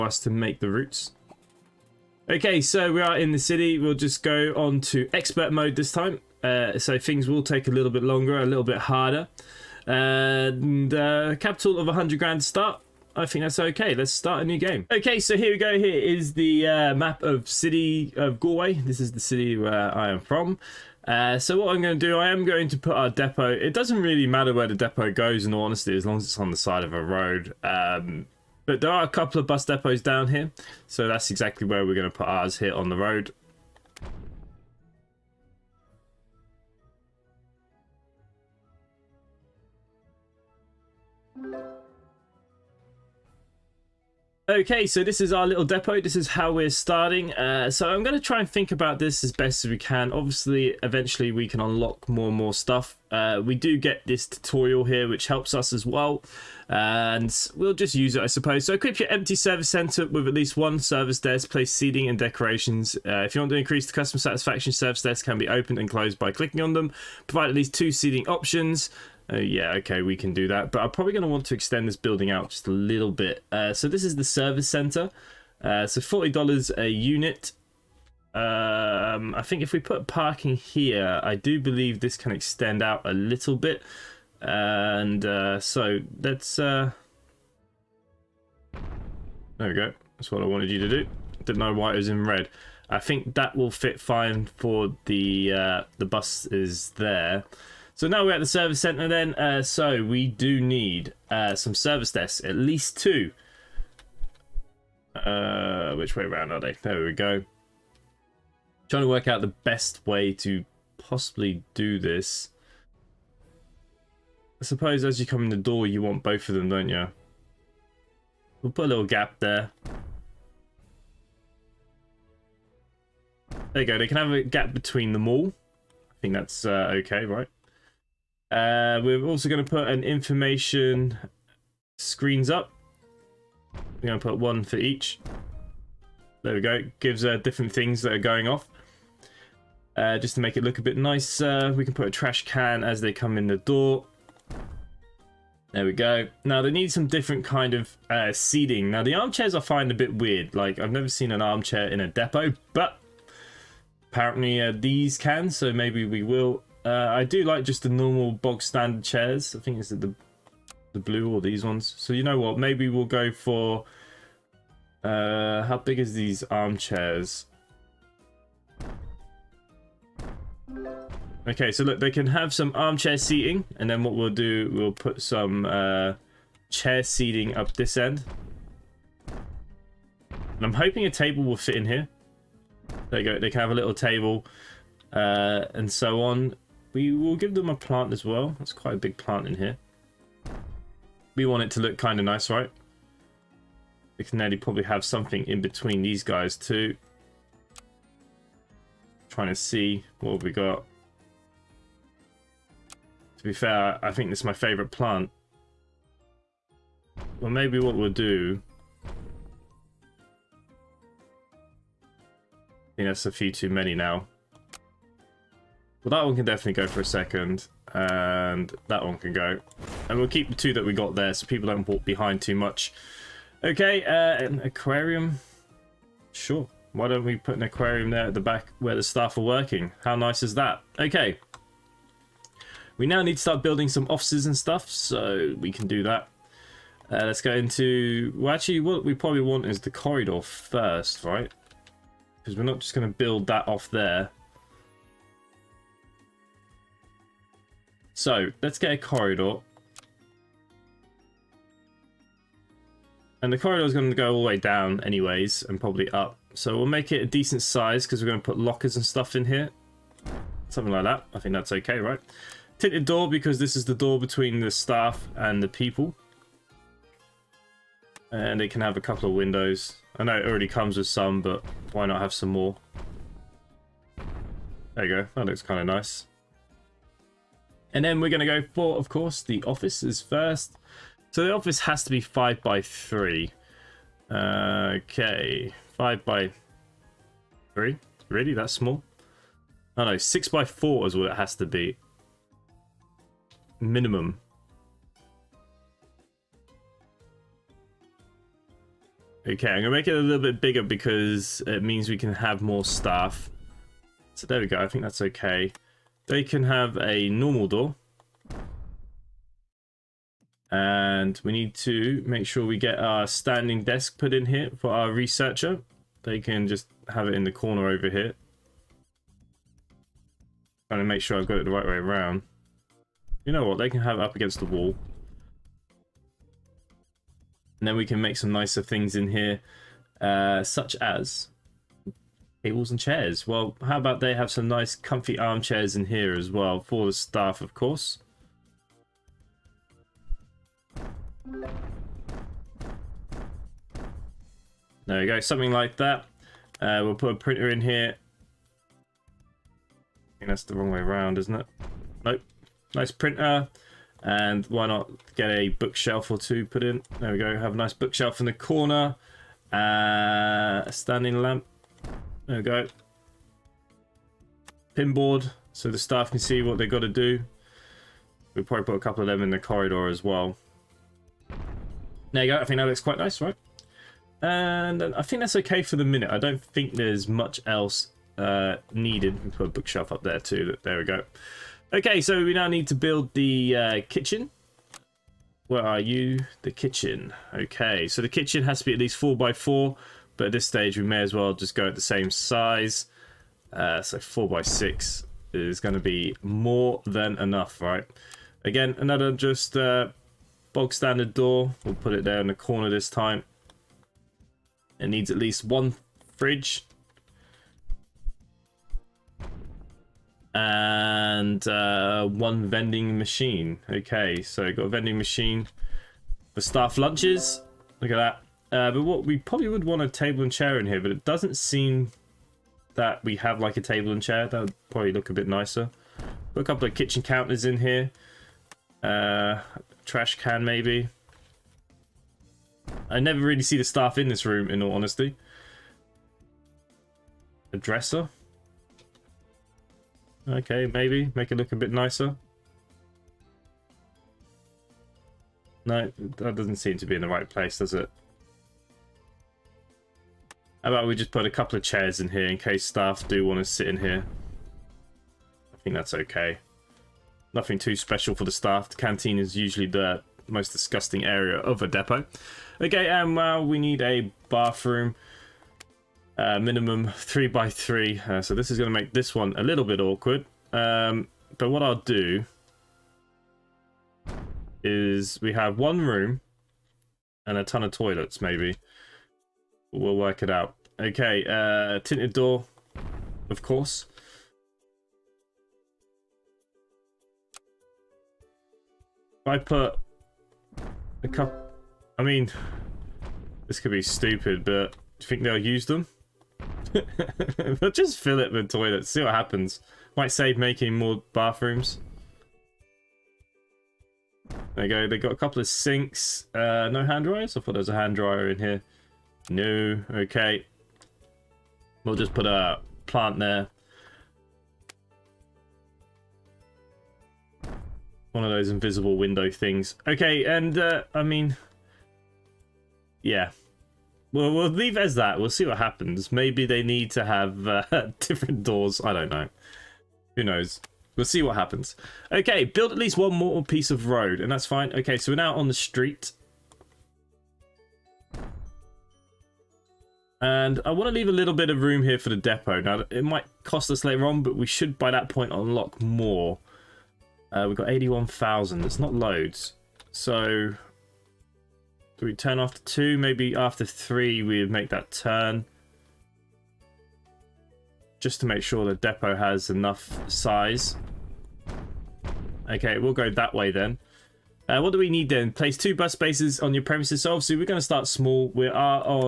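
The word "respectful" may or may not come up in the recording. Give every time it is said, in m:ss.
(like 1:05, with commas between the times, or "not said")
not said.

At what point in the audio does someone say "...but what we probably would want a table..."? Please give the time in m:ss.
6:58.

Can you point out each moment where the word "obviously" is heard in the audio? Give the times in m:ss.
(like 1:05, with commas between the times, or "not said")
0:50, 9:27.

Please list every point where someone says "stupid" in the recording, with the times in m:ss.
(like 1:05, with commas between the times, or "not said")
8:14.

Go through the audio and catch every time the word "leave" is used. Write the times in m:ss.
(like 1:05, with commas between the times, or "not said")
8:44, 9:01.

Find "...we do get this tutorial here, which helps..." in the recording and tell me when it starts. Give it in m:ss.
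0:53.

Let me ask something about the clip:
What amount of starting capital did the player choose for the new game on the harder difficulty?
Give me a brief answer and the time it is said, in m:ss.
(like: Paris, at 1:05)
100 grand, at 0:11.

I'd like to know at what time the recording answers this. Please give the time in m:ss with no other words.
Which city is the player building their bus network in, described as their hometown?
0:17.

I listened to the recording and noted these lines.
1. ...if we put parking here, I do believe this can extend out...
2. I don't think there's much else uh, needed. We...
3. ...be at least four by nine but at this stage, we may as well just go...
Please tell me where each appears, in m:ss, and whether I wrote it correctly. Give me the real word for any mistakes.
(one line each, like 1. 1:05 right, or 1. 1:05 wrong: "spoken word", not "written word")
1. 1:19 right
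2. 6:16 right
3. 6:28 wrong: "four", not "nine".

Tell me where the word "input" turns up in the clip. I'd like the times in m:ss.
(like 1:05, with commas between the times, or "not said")
not said.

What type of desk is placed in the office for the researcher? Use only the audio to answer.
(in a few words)
Standing desk.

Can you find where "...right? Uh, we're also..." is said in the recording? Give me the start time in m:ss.
2:07.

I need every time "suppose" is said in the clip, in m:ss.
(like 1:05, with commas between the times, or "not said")
0:58, 1:54.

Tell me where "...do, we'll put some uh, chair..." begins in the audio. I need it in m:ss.
2:54.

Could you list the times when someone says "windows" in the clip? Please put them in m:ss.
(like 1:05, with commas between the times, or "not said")
4:29, 8:39.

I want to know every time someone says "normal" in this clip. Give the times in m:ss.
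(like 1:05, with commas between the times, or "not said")
2:37, 5:07.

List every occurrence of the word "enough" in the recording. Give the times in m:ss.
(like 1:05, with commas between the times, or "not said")
6:37, 9:19.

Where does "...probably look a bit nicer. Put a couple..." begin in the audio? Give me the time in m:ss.
7:04.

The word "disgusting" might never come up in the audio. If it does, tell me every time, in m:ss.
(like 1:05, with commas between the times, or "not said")
7:40.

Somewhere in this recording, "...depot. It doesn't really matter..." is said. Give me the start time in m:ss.
0:23.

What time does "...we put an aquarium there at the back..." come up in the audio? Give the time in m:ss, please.
3:47.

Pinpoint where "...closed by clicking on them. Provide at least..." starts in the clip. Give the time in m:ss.
1:05.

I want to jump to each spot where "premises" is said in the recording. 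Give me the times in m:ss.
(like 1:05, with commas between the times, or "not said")
9:26.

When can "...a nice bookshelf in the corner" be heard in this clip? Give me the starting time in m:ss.
5:57.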